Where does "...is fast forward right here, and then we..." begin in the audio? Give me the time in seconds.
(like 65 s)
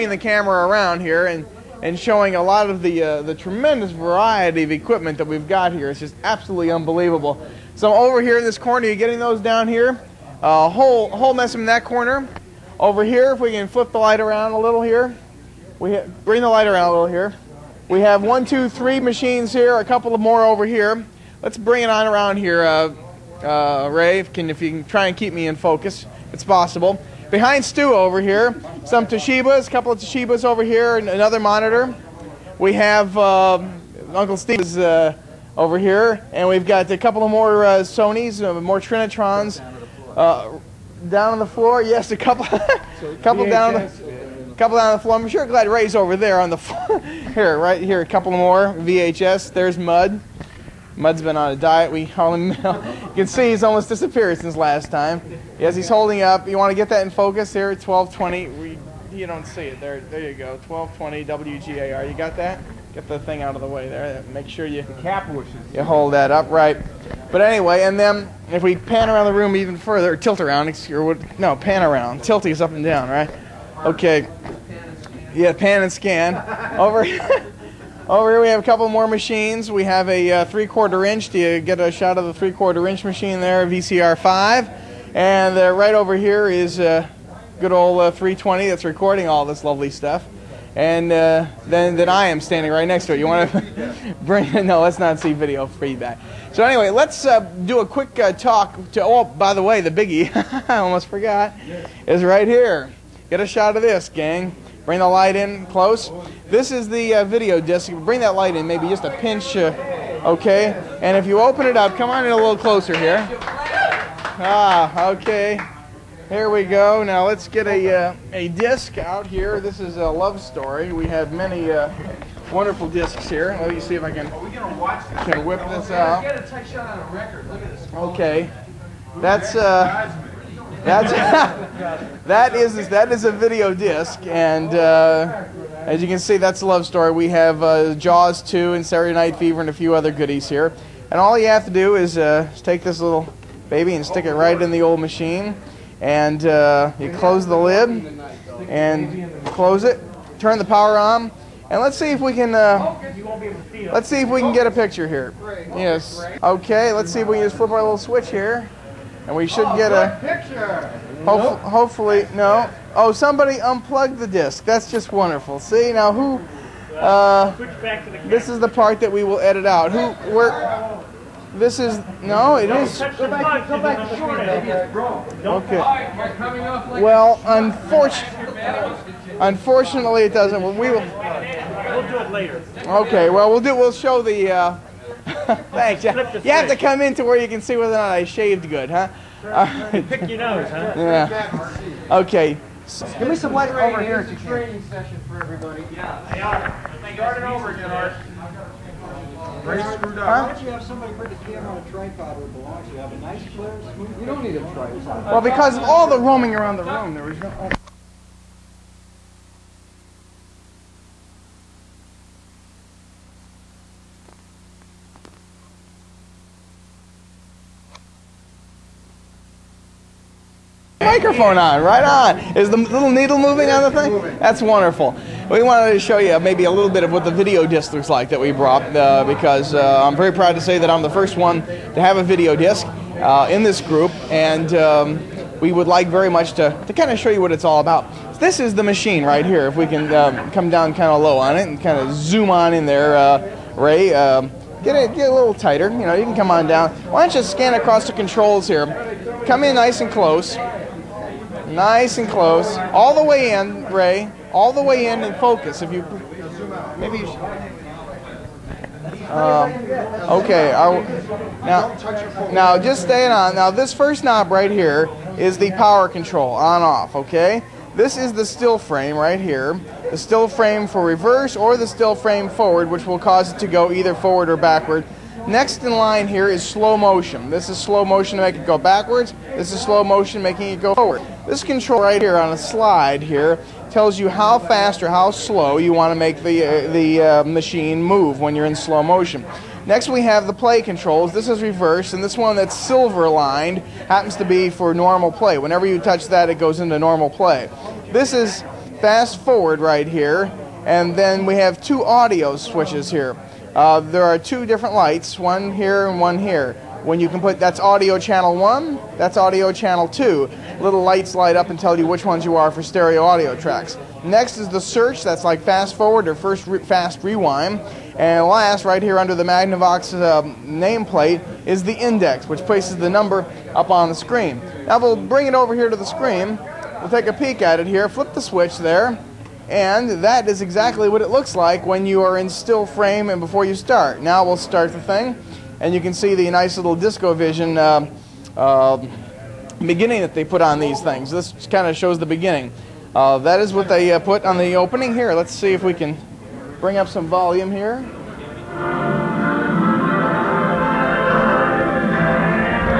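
298 s.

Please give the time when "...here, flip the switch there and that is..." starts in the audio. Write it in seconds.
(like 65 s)
327 s.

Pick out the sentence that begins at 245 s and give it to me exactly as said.
You know, you can come on down.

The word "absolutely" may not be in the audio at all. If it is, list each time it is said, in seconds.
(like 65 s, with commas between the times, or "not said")
6 s.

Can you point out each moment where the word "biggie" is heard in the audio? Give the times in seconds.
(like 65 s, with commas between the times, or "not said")
99 s.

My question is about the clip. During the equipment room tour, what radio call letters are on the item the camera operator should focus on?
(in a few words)
WGAR.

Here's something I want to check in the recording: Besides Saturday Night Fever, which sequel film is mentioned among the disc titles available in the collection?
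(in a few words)
Jaws 2.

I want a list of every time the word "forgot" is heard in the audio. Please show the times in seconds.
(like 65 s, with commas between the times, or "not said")
101 s.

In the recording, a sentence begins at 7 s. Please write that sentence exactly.
So over here in this corner, you're getting those down here.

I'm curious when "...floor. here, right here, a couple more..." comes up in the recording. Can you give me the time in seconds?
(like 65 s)
46 s.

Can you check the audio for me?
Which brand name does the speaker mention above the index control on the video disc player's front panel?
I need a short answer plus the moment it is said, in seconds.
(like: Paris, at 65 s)
Magnavox, at 319 s.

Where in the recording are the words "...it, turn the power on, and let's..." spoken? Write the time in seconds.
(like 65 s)
149 s.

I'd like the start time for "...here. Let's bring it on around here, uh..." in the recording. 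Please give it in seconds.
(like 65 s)
20 s.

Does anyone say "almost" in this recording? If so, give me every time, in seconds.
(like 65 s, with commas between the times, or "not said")
53 s, 100 s.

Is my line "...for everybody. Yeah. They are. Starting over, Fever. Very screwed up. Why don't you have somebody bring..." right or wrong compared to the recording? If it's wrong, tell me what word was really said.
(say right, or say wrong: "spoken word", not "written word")
wrong: "Denard", not "Fever".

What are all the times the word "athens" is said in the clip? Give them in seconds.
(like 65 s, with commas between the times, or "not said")
not said.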